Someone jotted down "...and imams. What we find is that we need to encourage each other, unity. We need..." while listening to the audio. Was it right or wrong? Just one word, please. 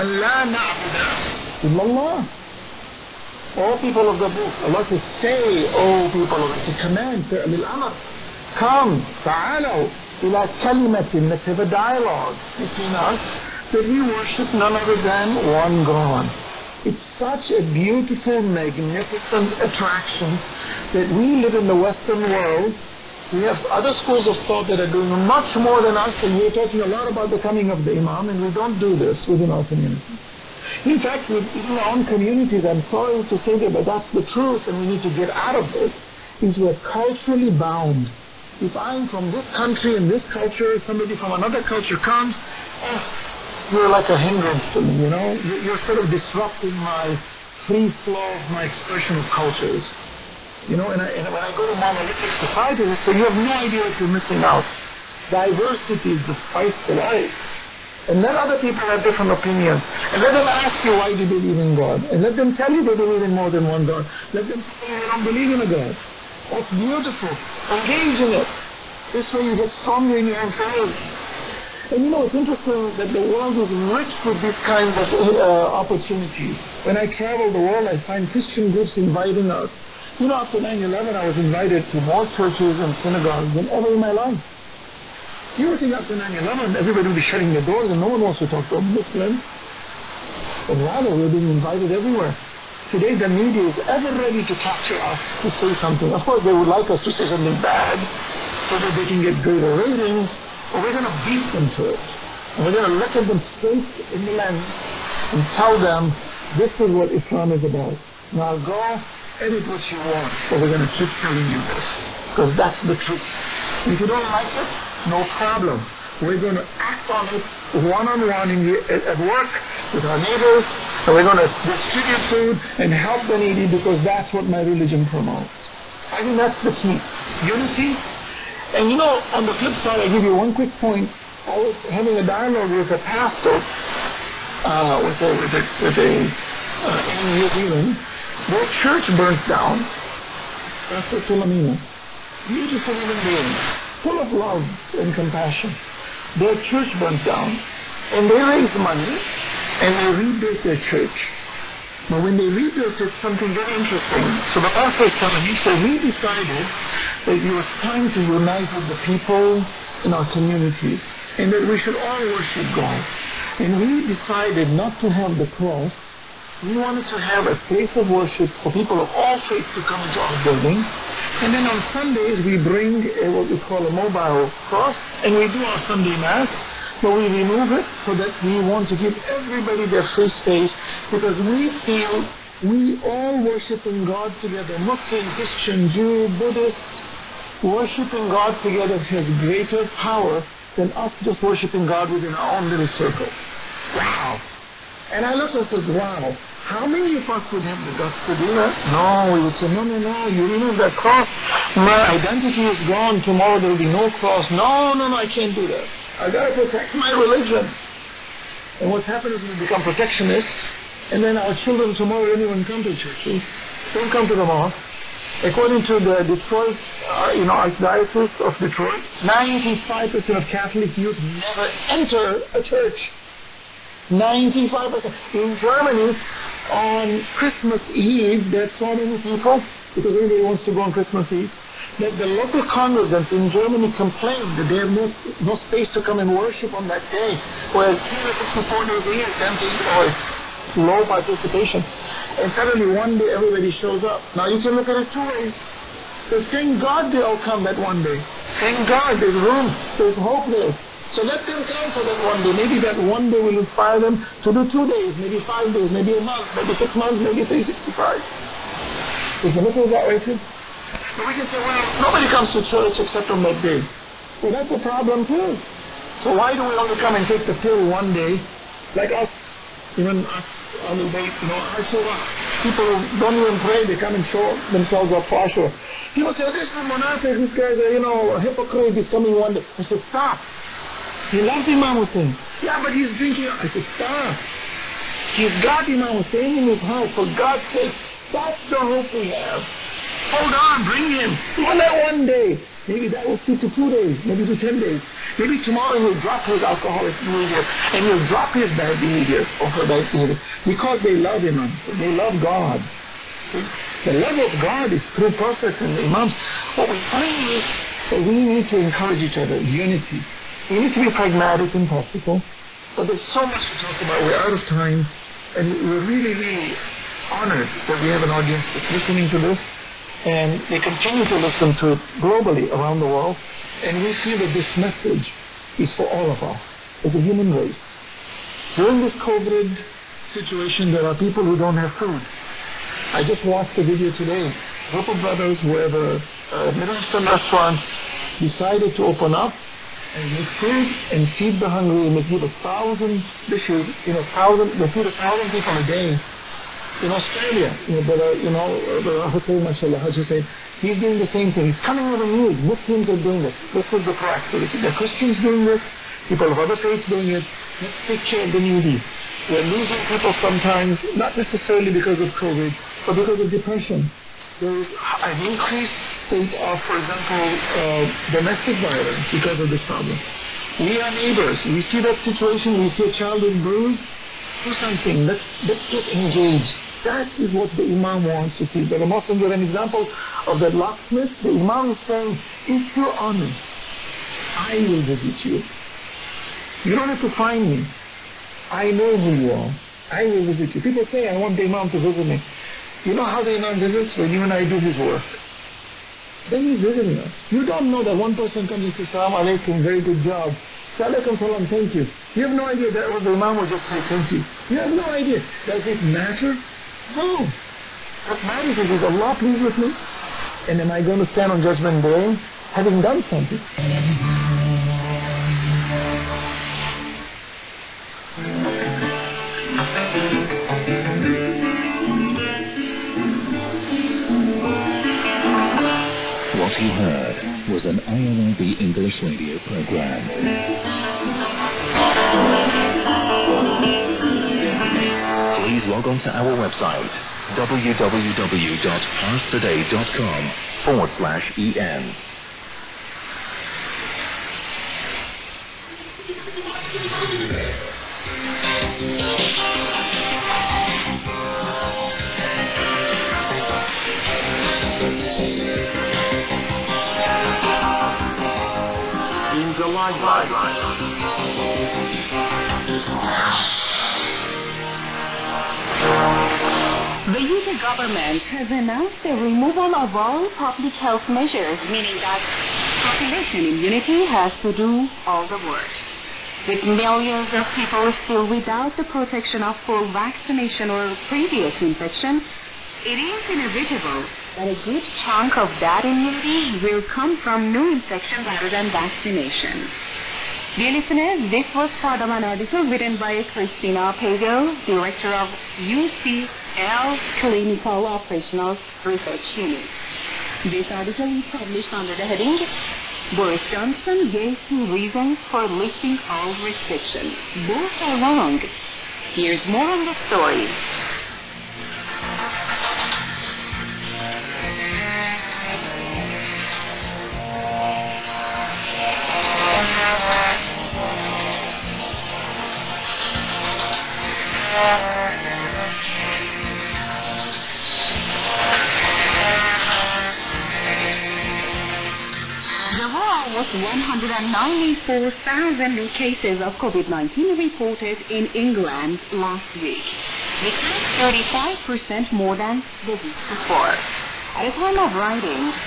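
right.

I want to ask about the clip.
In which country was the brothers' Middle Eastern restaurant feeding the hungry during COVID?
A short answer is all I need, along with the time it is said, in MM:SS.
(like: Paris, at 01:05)
Australia, at 05:47.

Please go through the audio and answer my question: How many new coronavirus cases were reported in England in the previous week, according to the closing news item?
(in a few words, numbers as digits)
194,000.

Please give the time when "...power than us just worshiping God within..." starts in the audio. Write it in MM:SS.
03:09.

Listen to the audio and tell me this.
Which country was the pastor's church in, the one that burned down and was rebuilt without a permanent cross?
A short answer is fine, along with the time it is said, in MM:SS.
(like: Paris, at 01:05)
New Zealand, at 02:17.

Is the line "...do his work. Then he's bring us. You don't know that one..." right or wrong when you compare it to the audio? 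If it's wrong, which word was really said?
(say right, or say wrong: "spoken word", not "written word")
wrong: "visiting", not "bring".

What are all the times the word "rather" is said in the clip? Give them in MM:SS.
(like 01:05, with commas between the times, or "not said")
01:30, 08:08.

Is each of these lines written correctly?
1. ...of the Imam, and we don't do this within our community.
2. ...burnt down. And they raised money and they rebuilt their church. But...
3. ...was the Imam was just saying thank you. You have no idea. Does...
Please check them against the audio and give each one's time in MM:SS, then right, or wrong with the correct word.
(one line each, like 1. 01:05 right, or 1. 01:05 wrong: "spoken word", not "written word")
1. 00:27 right
2. 02:26 right
3. 06:43 right.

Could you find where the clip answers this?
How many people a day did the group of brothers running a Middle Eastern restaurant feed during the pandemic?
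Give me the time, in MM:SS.
05:45.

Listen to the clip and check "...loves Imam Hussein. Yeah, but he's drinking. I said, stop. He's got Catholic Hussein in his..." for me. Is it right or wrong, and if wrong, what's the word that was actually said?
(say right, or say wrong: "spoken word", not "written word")
wrong: "Imam", not "Catholic".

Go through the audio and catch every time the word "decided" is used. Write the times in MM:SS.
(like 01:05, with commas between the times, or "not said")
02:36, 02:44, 05:38.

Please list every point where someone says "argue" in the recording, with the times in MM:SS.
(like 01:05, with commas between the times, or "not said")
not said.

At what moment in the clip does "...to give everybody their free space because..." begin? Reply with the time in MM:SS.
02:58.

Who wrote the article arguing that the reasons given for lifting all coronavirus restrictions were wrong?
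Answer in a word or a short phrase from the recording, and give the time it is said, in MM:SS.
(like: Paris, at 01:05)
Christina Pagel, at 08:13.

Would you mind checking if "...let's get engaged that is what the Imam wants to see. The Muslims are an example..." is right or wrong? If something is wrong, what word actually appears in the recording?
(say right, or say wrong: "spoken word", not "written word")
right.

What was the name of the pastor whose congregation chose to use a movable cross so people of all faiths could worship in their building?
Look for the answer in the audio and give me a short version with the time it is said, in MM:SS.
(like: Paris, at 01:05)
Pastor Tulamina, at 02:20.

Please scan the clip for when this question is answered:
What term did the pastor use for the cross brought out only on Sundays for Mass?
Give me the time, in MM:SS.
02:53.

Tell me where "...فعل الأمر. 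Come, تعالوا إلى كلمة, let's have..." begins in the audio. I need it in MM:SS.
00:07.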